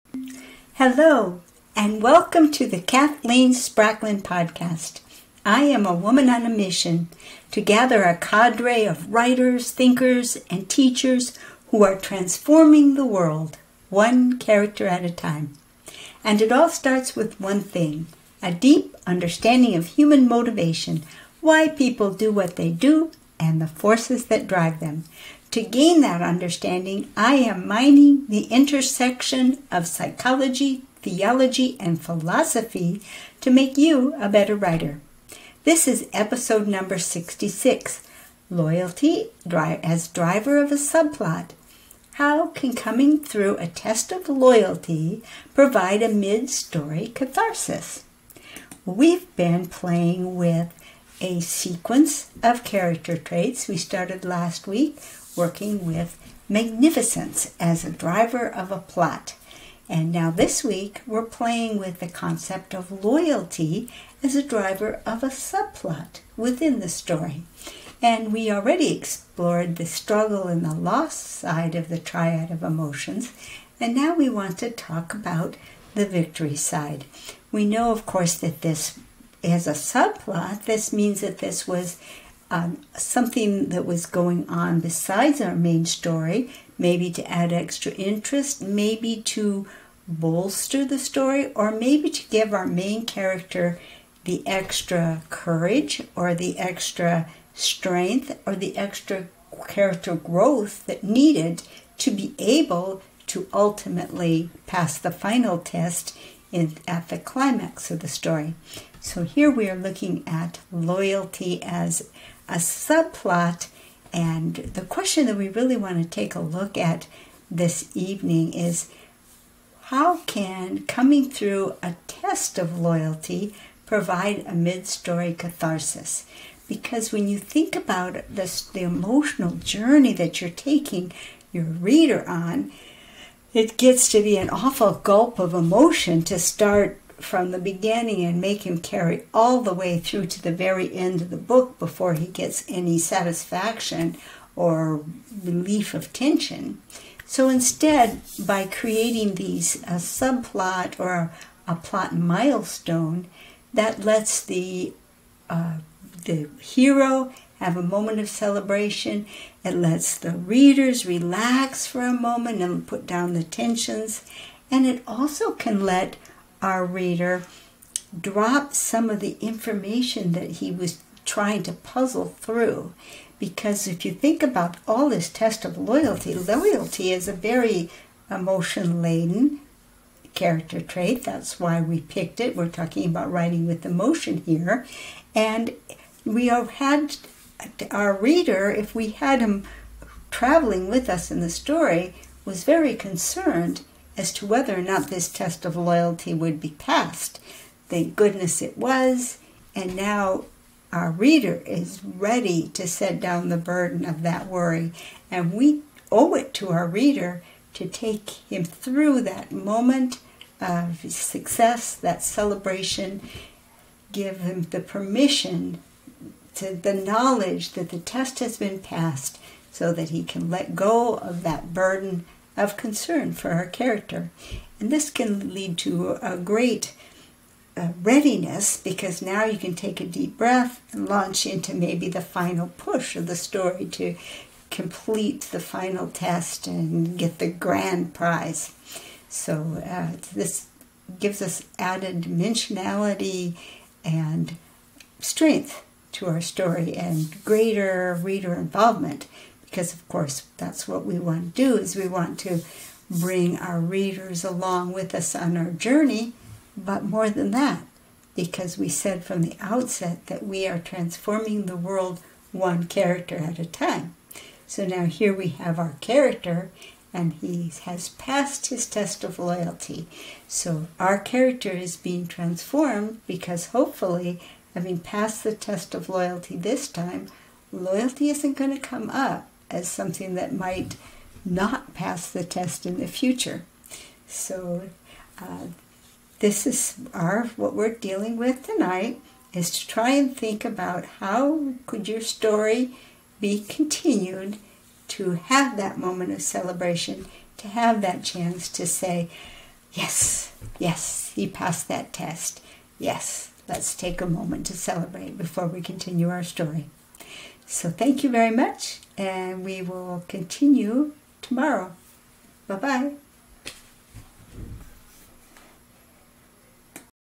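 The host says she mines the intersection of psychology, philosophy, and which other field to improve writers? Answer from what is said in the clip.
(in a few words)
theology.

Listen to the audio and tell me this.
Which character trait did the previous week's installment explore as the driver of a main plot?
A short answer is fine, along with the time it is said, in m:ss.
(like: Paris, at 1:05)
magnificence, at 0:56.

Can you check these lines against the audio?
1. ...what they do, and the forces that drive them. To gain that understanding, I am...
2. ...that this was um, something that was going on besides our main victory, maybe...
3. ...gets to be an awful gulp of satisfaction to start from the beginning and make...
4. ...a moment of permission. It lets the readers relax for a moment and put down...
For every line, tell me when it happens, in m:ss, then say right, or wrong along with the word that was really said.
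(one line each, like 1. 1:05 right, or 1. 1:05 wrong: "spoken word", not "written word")
1. 0:22 right
2. 1:21 wrong: "story", not "victory"
3. 2:13 wrong: "emotion", not "satisfaction"
4. 2:37 wrong: "celebration", not "permission".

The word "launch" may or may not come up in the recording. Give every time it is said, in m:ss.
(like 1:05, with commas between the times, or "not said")
3:51.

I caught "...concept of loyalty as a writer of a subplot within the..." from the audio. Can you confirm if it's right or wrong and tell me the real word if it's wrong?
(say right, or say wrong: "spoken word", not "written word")
wrong: "driver", not "writer".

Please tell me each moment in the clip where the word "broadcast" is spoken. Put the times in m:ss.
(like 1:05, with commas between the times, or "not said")
not said.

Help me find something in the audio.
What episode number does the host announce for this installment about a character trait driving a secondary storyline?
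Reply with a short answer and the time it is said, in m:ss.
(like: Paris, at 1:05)
66, at 0:36.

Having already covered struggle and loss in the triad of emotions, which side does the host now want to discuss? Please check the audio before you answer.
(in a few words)
the victory side.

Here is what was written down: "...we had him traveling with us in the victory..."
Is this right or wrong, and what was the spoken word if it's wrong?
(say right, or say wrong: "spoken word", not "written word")
wrong: "story", not "victory".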